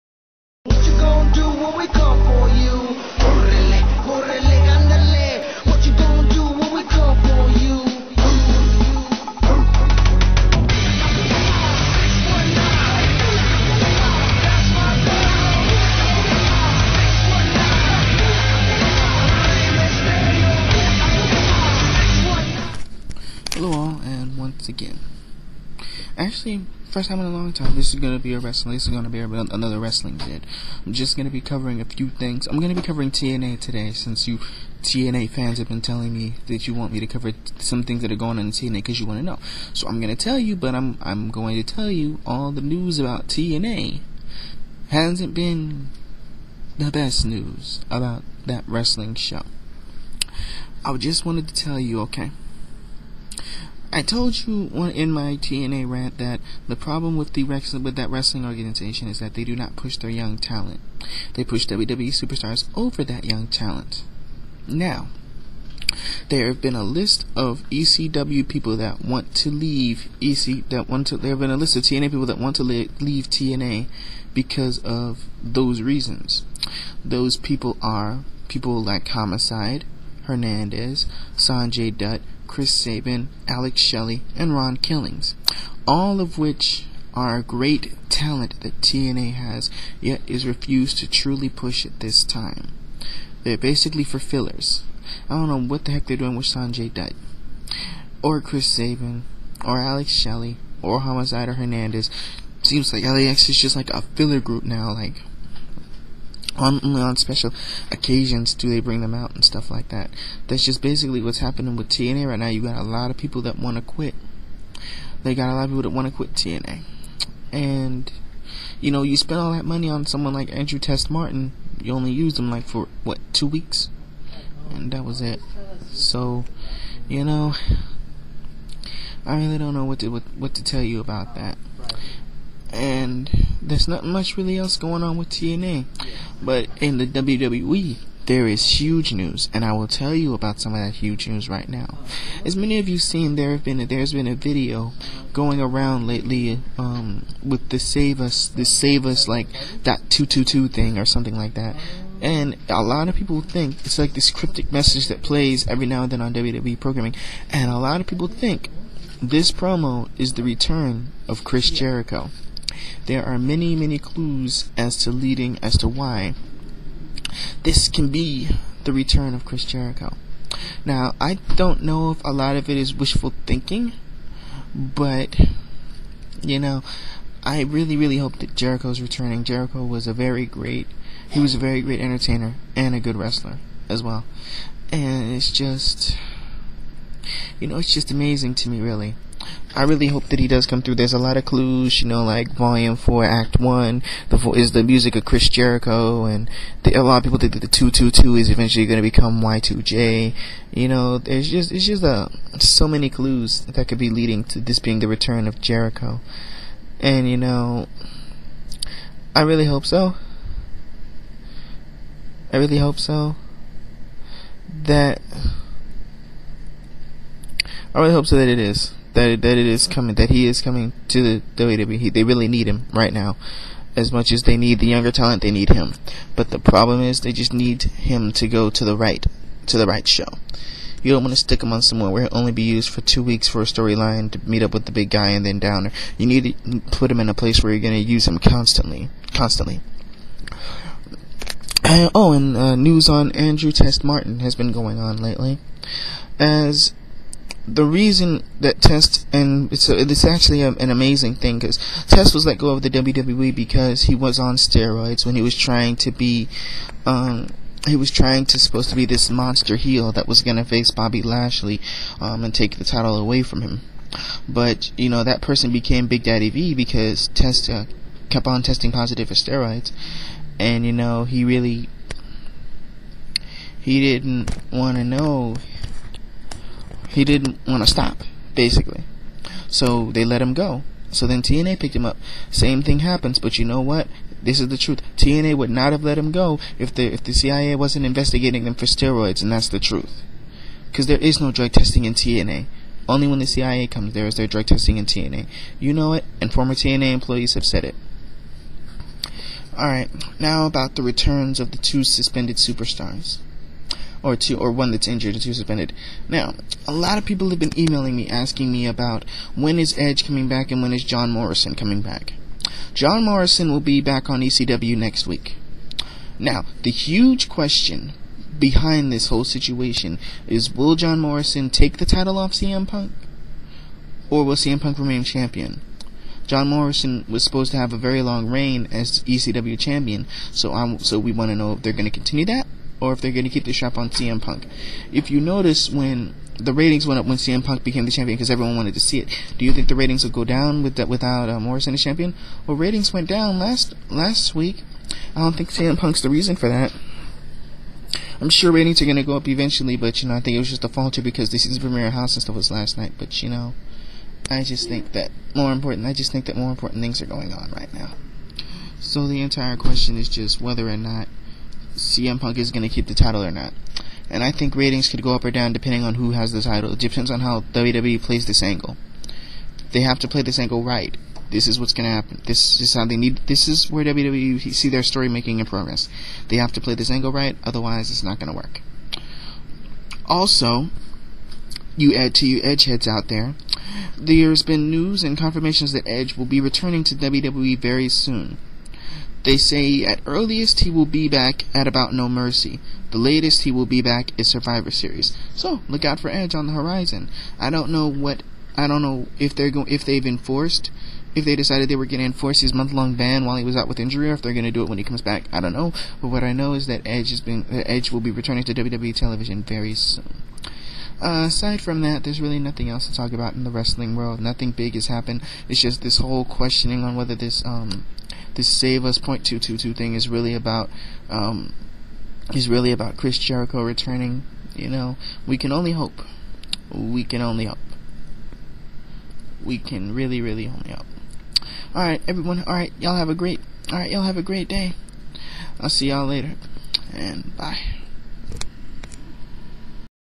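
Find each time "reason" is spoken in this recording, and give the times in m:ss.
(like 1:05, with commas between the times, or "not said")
1:15, 4:07, 5:46.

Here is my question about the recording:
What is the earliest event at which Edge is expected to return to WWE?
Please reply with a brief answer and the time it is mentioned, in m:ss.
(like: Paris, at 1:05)
No Mercy, at 6:32.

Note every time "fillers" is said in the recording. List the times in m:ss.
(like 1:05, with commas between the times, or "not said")
1:34, 1:44.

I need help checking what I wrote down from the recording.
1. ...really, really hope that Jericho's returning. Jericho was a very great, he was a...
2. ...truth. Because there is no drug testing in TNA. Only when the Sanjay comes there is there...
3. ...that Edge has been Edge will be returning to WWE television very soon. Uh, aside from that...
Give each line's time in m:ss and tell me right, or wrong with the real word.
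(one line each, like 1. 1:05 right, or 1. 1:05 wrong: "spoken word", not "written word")
1. 2:57 right
2. 4:49 wrong: "CIA", not "Sanjay"
3. 6:46 right.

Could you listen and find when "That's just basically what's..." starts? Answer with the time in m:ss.
1:50.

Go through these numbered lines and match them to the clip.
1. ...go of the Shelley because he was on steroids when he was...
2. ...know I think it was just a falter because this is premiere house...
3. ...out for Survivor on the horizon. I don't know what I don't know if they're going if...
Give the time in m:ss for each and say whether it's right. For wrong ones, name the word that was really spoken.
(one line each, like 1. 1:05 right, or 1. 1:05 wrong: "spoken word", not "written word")
1. 4:12 wrong: "WWE", not "Shelley"
2. 5:50 right
3. 6:36 wrong: "Edge", not "Survivor".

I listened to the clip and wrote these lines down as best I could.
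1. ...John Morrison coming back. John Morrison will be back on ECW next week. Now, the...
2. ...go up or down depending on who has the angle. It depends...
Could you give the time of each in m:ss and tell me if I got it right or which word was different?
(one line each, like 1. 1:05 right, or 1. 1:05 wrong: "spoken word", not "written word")
1. 5:11 right
2. 6:05 wrong: "title", not "angle".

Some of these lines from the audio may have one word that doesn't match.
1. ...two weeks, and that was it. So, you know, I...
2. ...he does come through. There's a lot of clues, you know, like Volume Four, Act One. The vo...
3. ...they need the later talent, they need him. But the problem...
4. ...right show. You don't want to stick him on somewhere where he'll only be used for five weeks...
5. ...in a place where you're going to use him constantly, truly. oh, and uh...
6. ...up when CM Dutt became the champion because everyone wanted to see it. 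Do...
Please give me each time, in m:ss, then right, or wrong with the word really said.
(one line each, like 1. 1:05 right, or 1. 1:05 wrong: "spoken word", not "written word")
1. 2:03 right
2. 3:10 right
3. 3:44 wrong: "younger", not "later"
4. 3:49 wrong: "two", not "five"
5. 3:57 wrong: "constantly", not "truly"
6. 5:37 wrong: "Punk", not "Dutt".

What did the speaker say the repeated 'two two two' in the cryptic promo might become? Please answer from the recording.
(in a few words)
Y2J.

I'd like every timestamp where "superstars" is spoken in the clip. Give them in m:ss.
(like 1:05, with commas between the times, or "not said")
1:02, 5:02.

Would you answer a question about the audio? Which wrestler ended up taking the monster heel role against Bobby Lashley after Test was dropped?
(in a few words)
Big Daddy V.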